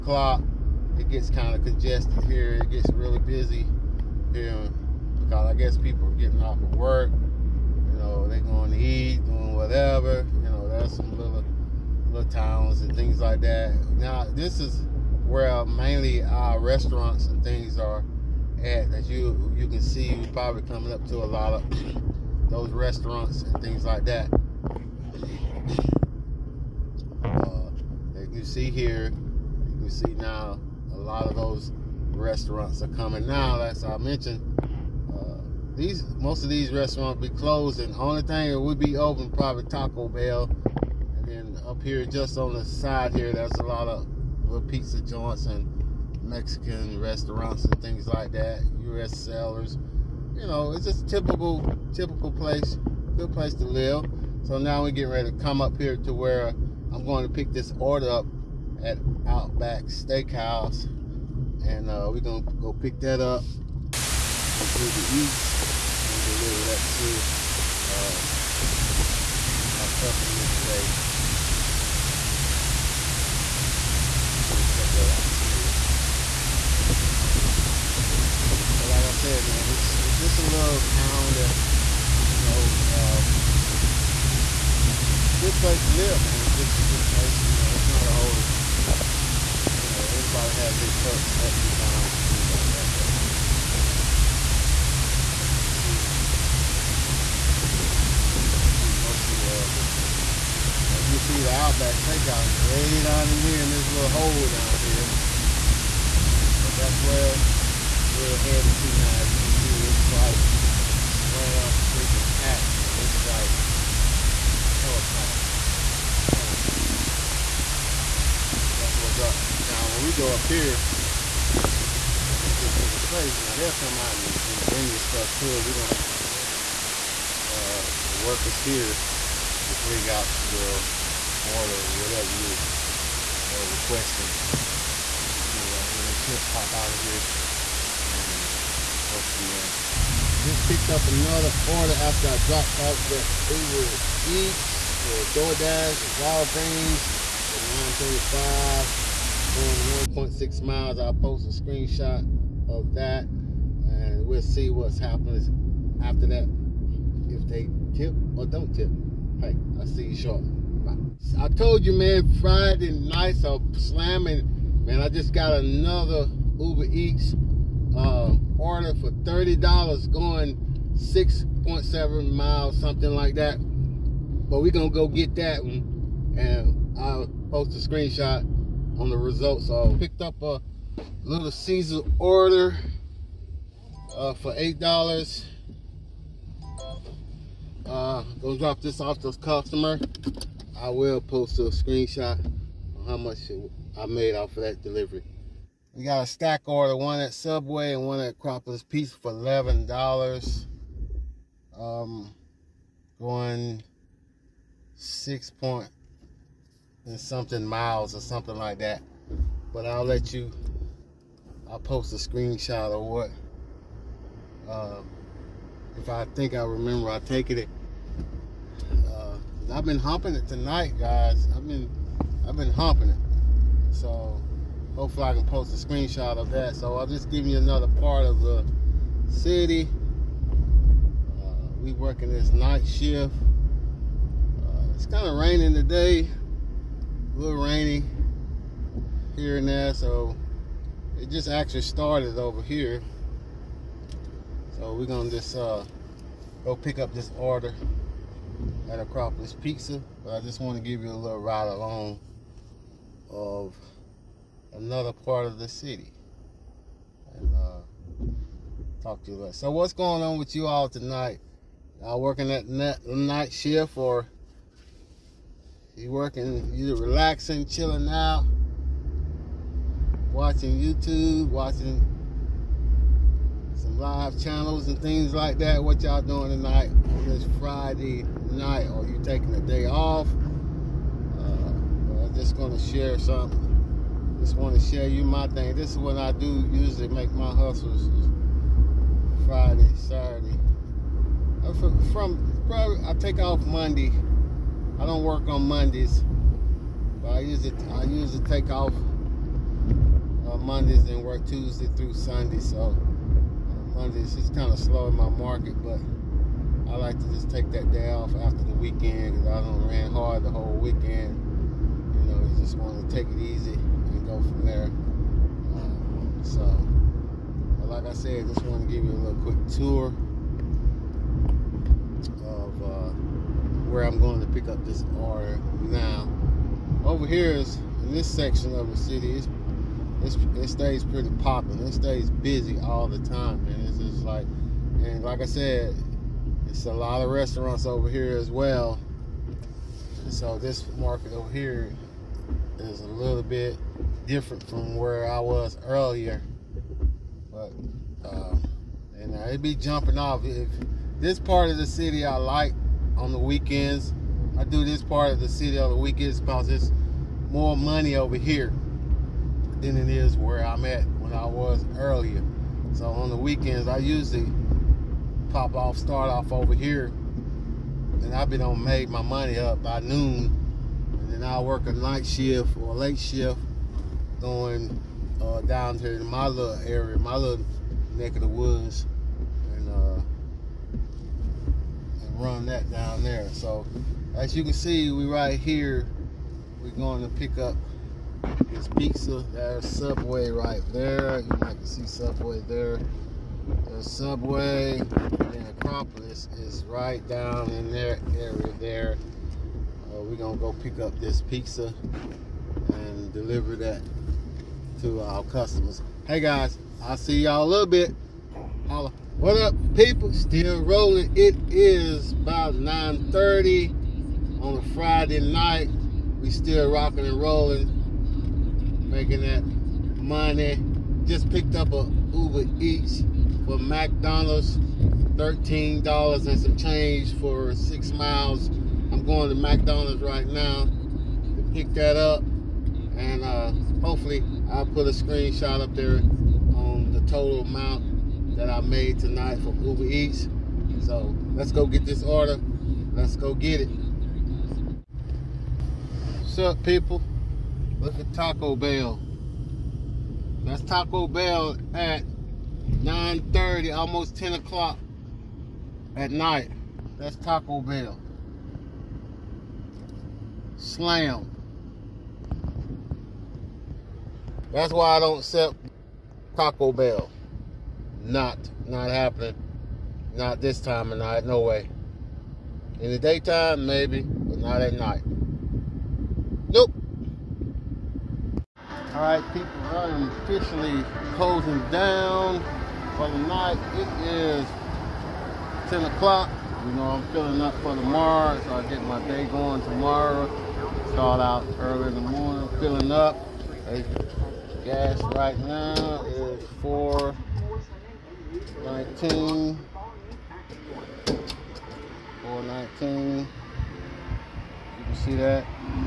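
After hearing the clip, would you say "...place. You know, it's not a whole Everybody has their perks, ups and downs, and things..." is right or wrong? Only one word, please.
right.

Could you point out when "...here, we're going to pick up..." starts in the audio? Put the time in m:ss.
6:25.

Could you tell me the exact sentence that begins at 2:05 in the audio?
We don't have to go in there.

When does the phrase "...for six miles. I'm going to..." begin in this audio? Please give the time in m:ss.
7:07.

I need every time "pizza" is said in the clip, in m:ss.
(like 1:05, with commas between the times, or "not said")
0:44, 3:18, 4:09, 6:28, 6:41.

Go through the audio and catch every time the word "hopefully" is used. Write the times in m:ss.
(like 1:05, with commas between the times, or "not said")
3:44, 7:14.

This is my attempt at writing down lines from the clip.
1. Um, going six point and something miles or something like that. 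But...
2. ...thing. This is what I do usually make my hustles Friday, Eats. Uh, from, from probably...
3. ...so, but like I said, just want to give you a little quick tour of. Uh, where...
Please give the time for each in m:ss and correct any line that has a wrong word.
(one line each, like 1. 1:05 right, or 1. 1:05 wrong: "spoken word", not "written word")
1. 3:21 right
2. 4:45 wrong: "Saturday", not "Eats"
3. 5:16 right.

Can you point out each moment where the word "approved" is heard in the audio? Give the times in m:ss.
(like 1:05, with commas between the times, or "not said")
not said.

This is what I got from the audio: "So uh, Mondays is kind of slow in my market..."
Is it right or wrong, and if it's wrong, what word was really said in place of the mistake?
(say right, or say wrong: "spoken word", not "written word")
right.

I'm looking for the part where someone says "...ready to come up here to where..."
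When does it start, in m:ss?
0:55.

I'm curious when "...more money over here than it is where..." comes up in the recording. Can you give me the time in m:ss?
5:57.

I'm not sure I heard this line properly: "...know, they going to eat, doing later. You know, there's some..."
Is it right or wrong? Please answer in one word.
wrong.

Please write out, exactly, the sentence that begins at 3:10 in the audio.
I will post a screenshot on how much I made off of that delivery.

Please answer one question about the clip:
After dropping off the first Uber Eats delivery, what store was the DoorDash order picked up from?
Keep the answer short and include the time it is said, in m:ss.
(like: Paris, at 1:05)
Walgreens, at 2:26.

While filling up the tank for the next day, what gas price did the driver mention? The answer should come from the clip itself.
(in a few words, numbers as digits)
4.19.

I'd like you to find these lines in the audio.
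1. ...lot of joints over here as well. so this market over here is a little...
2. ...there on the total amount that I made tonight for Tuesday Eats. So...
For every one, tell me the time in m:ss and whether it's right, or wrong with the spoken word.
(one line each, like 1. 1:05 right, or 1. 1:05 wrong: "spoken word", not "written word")
1. 5:36 wrong: "restaurants", not "joints"
2. 7:15 wrong: "Uber", not "Tuesday".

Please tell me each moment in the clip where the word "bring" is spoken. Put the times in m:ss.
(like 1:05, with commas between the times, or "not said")
2:04, 2:09.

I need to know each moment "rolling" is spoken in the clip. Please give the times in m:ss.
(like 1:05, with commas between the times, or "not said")
6:50, 6:57.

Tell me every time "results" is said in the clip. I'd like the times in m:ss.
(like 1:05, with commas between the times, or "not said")
2:59.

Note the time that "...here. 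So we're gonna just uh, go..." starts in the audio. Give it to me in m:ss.
4:02.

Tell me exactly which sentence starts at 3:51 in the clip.
Uh, we working this night shift.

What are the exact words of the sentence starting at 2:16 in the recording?
They should pop out of here and go from there.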